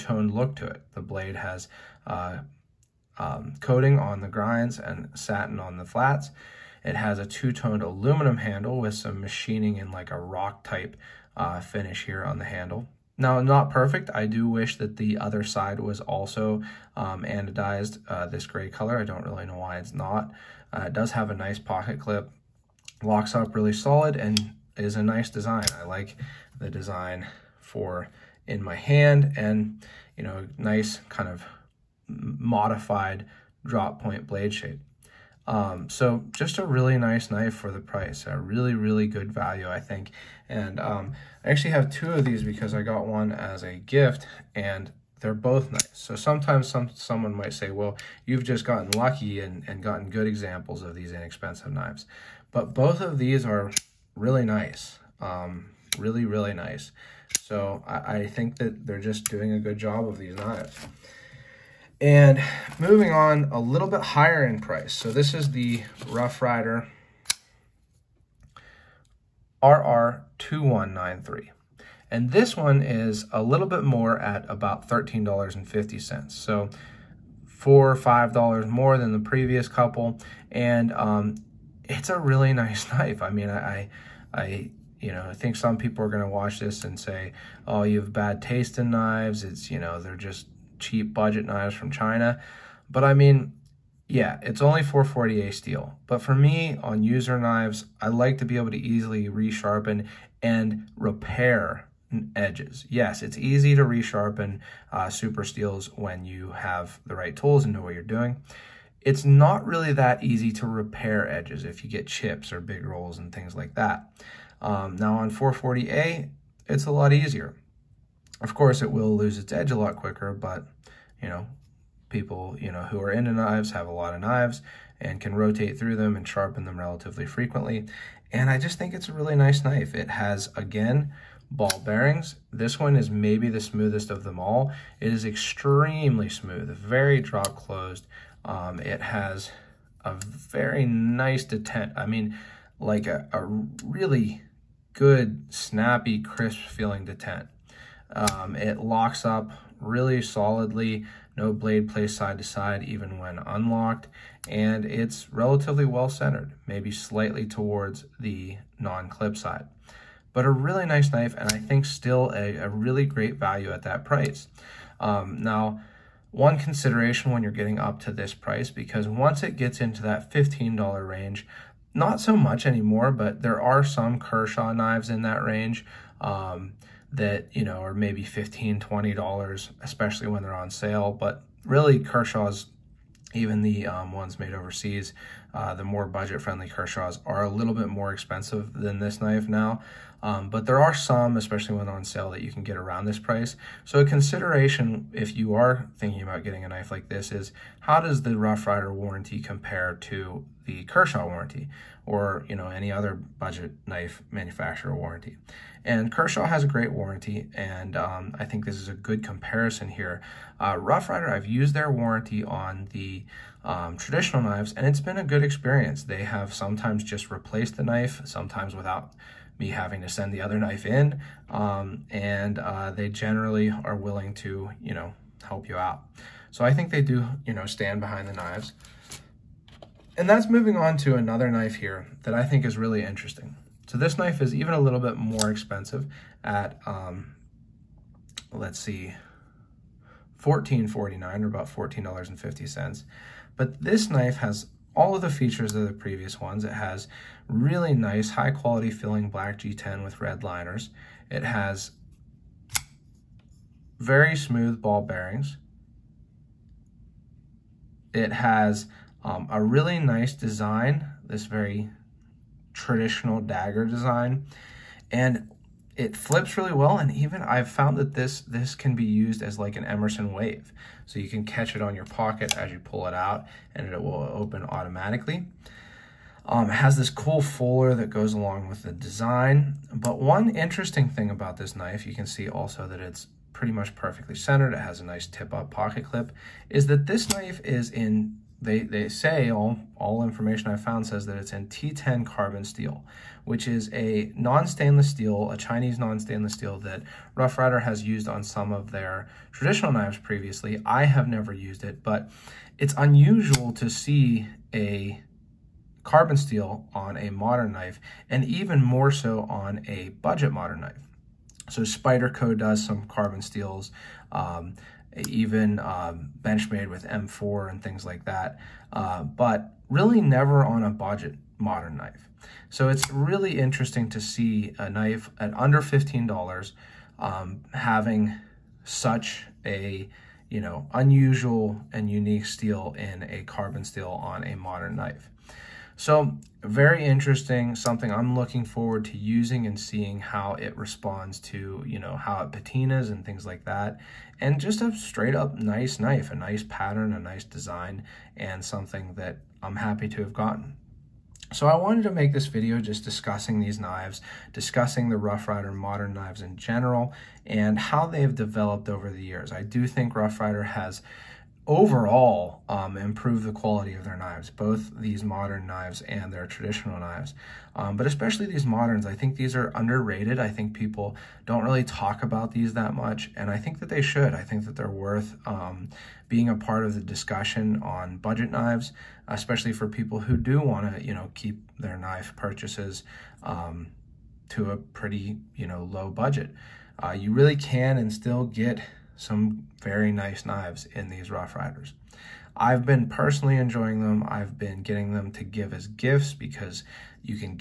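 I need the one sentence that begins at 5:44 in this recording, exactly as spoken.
And just a straight up nice knife, a nice pattern, a nice design, and something that I'm happy to have gotten.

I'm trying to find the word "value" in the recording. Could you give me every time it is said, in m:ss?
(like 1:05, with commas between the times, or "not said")
0:39, 2:43.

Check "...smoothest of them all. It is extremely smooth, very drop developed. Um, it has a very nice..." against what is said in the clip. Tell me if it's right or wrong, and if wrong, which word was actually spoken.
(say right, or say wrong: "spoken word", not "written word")
wrong: "closed", not "developed".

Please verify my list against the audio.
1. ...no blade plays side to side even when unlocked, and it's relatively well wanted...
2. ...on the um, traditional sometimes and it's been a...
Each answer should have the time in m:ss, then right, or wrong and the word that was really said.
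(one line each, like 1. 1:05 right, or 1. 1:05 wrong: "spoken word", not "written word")
1. 2:31 wrong: "centered", not "wanted"
2. 3:32 wrong: "knives", not "sometimes".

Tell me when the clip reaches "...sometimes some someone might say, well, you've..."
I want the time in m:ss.
0:46.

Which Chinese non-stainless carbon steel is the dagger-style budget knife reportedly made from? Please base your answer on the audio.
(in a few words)
T10.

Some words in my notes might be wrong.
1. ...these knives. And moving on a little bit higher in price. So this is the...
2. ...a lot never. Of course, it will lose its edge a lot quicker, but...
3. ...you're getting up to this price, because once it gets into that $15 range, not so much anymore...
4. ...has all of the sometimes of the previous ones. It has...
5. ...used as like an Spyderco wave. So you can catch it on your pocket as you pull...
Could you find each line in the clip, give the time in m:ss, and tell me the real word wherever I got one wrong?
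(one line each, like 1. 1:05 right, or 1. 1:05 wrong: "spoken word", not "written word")
1. 1:00 right
2. 1:56 wrong: "easier", not "never"
3. 2:47 right
4. 4:04 wrong: "features", not "sometimes"
5. 4:29 wrong: "Emerson", not "Spyderco".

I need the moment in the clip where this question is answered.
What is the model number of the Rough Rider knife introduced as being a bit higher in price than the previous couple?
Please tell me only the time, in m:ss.
1:09.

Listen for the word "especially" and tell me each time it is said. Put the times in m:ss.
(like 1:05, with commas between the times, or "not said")
2:59, 3:11, 6:08, 6:19.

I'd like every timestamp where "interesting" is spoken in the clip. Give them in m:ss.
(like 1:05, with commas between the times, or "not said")
3:53, 4:40, 5:23, 5:37.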